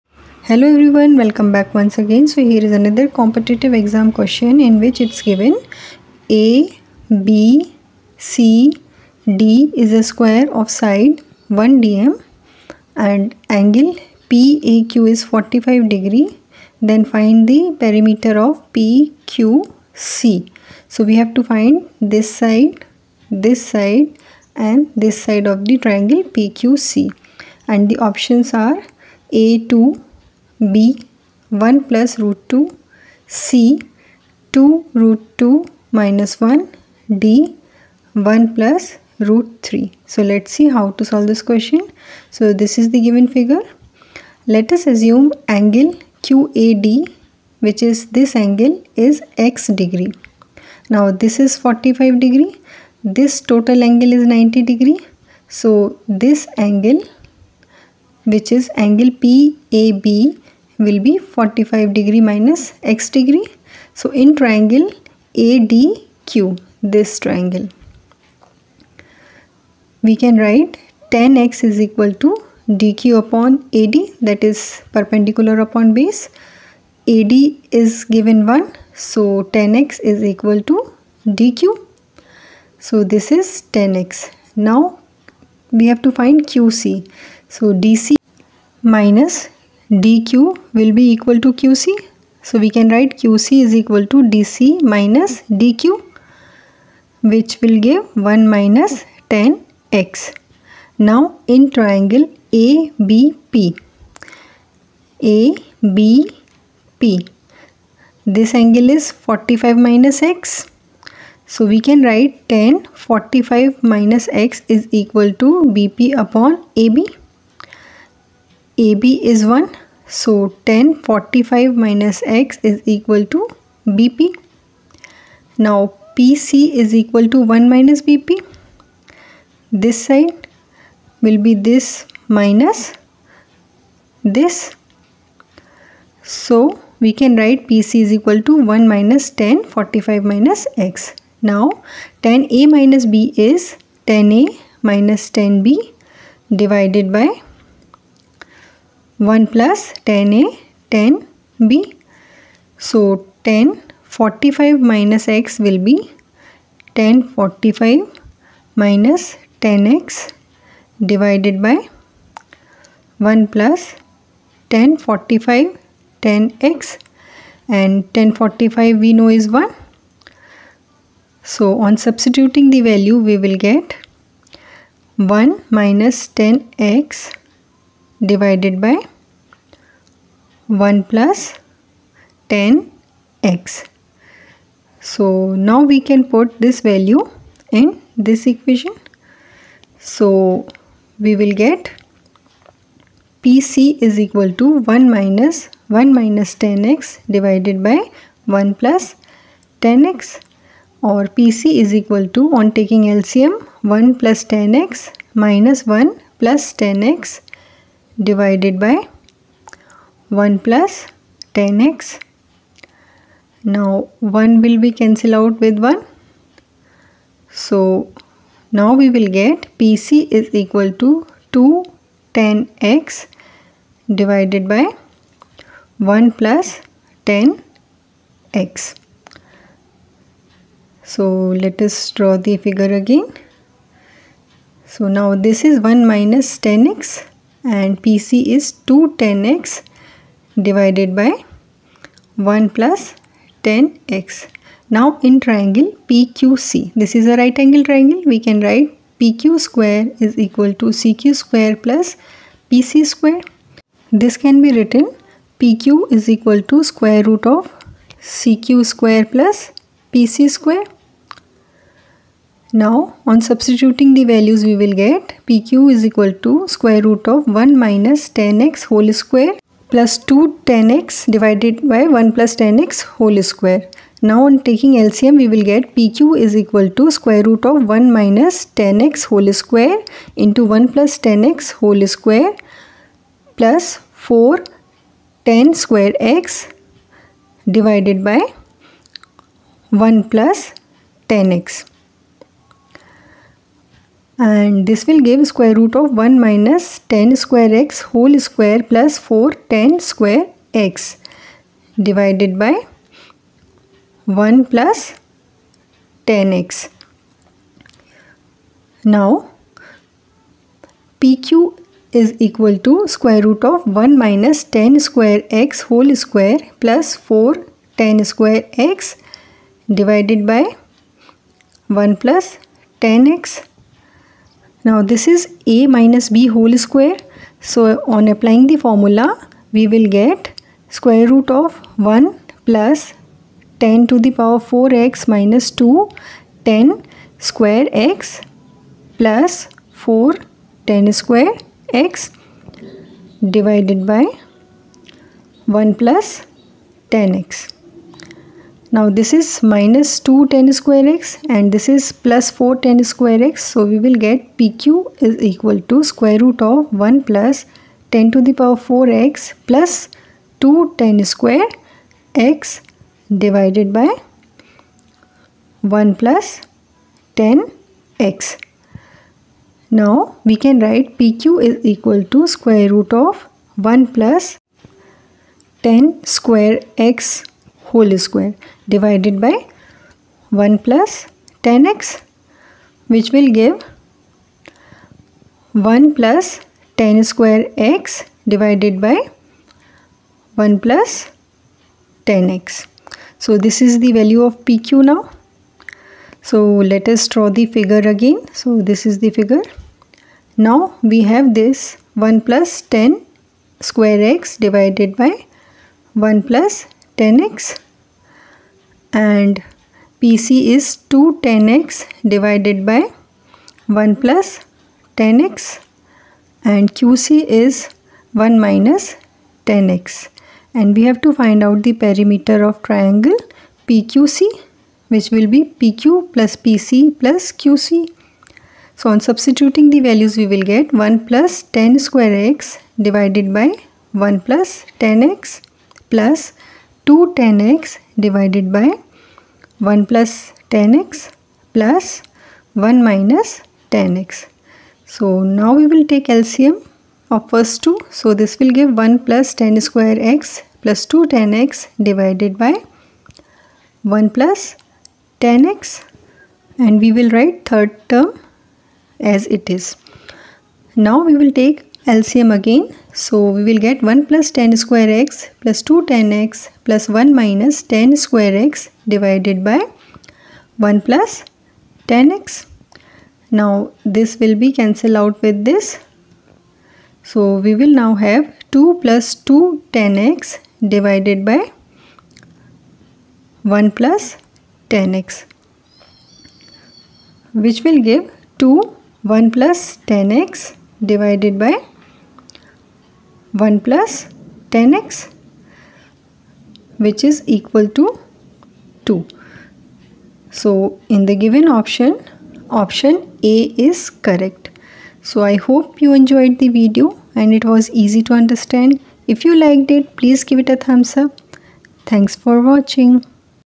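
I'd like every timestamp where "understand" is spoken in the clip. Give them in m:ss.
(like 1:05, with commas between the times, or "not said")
8:28.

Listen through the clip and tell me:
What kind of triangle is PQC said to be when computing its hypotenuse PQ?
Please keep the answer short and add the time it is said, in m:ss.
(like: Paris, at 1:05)
right angle triangle, at 4:07.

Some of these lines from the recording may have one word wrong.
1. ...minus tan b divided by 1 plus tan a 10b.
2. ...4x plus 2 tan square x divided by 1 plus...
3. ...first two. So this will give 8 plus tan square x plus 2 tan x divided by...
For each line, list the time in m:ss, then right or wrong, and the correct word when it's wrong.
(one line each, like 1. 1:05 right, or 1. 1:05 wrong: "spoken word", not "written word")
1. 2:24 right
2. 5:58 right
3. 7:27 wrong: "1", not "8".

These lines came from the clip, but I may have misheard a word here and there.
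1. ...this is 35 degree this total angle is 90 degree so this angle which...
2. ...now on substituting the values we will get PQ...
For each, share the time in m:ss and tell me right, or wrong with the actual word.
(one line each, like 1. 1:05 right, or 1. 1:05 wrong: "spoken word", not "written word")
1. 0:51 wrong: "45", not "35"
2. 4:22 right.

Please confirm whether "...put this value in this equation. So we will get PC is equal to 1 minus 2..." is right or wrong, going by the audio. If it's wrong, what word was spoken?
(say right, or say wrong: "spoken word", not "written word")
wrong: "1", not "2".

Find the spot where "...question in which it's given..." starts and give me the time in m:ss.
0:04.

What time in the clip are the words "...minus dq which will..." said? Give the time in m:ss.
1:34.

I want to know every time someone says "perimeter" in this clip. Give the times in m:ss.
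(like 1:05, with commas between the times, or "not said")
0:17, 7:02.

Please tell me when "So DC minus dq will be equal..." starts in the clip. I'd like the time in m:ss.
1:27.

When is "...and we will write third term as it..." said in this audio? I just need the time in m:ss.
7:36.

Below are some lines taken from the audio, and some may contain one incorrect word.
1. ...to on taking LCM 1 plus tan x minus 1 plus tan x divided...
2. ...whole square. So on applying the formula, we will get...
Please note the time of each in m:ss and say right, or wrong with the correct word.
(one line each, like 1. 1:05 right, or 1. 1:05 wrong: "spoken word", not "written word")
1. 3:22 right
2. 5:26 right.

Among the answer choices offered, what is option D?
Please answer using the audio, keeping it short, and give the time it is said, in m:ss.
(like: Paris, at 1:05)
1 + root 3, at 0:37.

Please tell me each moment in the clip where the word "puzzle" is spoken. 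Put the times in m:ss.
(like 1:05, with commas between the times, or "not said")
not said.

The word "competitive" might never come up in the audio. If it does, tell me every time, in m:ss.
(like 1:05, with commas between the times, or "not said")
0:03.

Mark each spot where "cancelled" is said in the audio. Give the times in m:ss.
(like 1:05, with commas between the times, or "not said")
3:34, 7:54.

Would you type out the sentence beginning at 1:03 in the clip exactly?
So in triangle ADQ, this triangle, we can write tan x is equal to dq upon AD that is perpendicular upon base.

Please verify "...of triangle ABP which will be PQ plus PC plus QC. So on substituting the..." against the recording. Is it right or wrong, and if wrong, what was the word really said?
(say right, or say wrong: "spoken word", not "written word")
wrong: "PQC", not "ABP".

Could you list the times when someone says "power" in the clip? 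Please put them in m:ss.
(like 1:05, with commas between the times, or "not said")
5:34, 5:58.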